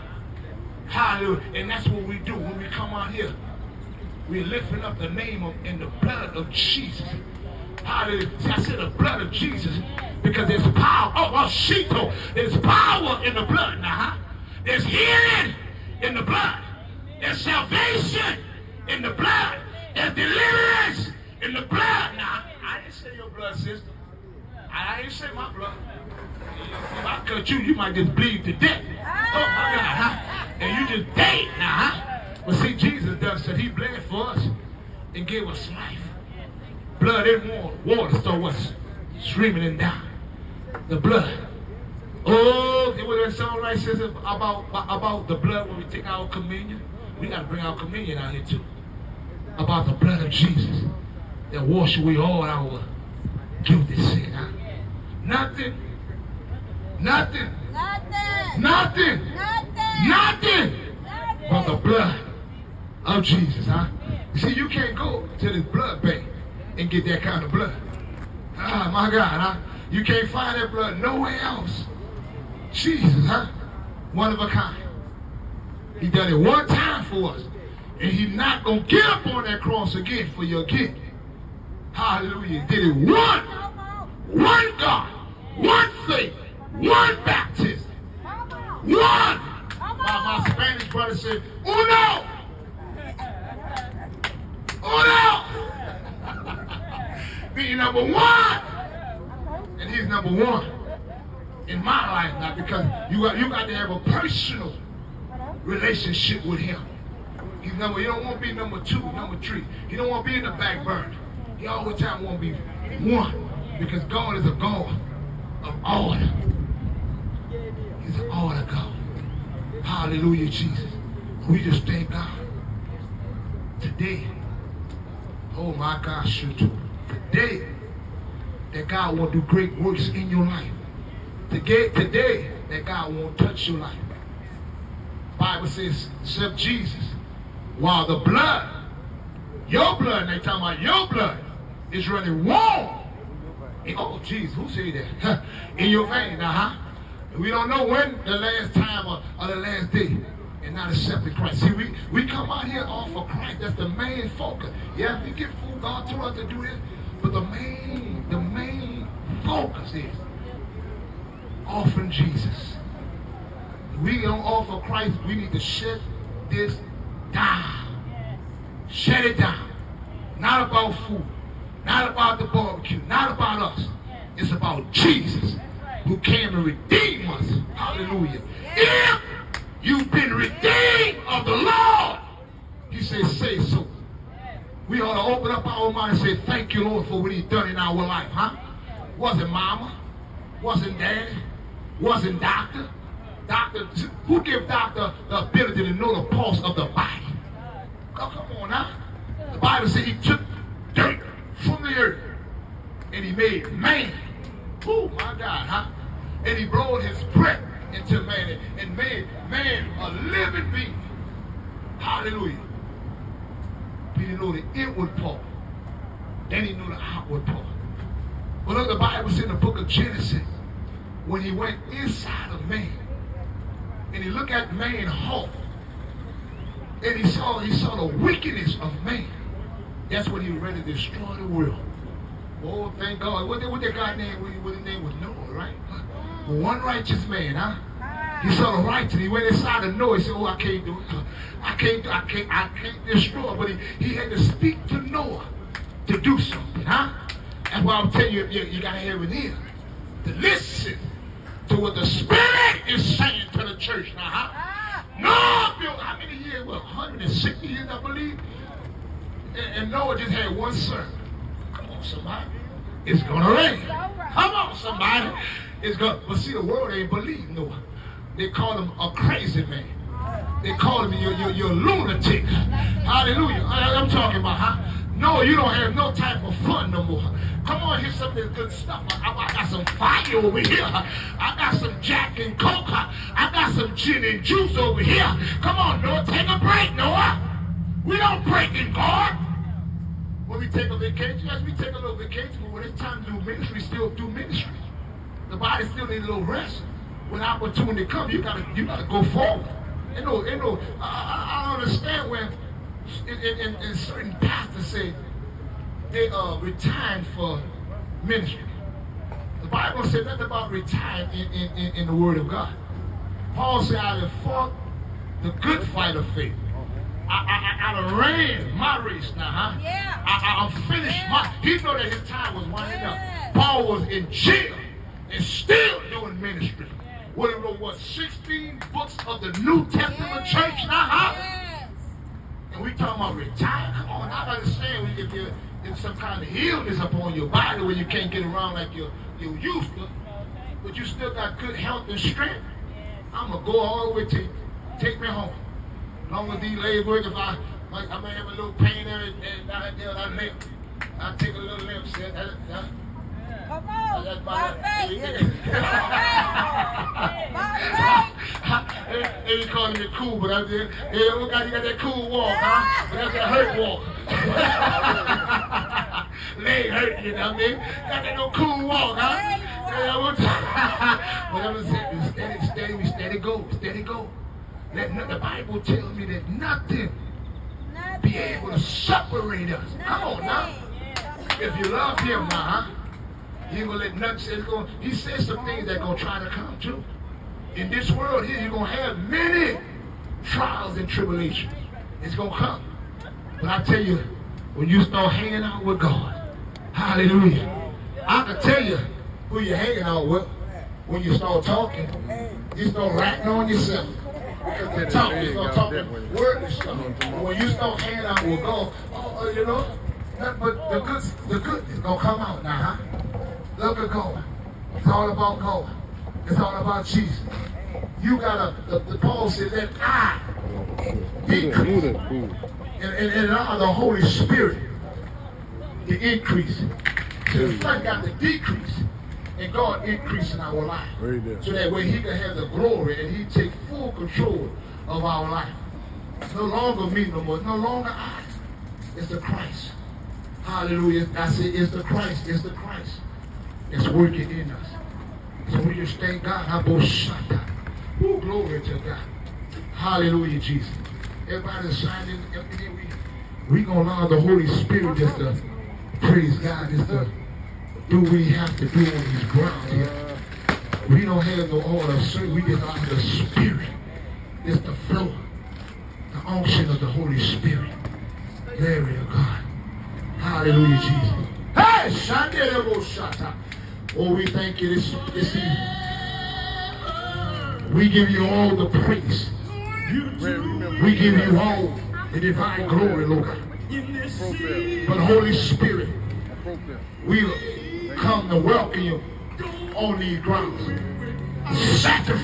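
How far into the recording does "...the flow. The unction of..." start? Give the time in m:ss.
7:44.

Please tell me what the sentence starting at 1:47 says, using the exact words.
He's number, you don't want to be number two, number three.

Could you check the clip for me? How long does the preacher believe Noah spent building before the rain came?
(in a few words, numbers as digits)
160 years.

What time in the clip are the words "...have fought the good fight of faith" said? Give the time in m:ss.
5:14.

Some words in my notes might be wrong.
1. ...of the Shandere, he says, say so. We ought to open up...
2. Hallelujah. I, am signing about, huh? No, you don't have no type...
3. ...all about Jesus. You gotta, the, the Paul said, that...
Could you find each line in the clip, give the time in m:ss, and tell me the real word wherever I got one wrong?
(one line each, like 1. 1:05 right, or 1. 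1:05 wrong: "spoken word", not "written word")
1. 3:01 wrong: "Lord", not "Shandere"
2. 4:32 wrong: "talking", not "signing"
3. 6:56 right.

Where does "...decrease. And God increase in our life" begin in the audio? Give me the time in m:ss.
7:08.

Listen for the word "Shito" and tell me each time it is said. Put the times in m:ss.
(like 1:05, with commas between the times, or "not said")
0:11.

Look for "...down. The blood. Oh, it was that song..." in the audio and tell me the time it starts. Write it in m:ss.
0:39.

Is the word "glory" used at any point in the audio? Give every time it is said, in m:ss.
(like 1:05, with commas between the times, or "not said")
7:12, 7:28, 7:48, 8:02.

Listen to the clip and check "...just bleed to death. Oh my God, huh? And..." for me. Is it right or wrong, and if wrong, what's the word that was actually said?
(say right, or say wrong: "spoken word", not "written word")
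right.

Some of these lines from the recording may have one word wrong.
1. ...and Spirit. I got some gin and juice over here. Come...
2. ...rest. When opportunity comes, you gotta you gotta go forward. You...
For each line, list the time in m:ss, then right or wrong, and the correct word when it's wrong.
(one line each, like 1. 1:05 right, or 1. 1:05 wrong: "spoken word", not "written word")
1. 4:42 wrong: "Coke", not "Spirit"
2. 4:56 right.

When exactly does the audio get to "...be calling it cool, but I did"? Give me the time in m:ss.
5:59.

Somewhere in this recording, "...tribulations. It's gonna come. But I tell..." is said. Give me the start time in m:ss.
6:31.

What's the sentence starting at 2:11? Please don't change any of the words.
Today, today that God won't touch your life.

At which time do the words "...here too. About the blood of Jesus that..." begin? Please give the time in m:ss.
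0:48.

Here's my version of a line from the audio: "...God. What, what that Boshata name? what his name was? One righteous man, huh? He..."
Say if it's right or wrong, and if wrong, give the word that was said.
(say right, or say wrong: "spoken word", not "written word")
wrong: "God", not "Boshata".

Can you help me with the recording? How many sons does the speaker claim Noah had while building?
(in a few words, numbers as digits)
one son.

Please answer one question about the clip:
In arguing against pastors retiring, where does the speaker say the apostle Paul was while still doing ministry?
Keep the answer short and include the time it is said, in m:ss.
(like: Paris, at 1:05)
jail, at 5:24.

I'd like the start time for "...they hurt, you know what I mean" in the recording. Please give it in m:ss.
6:06.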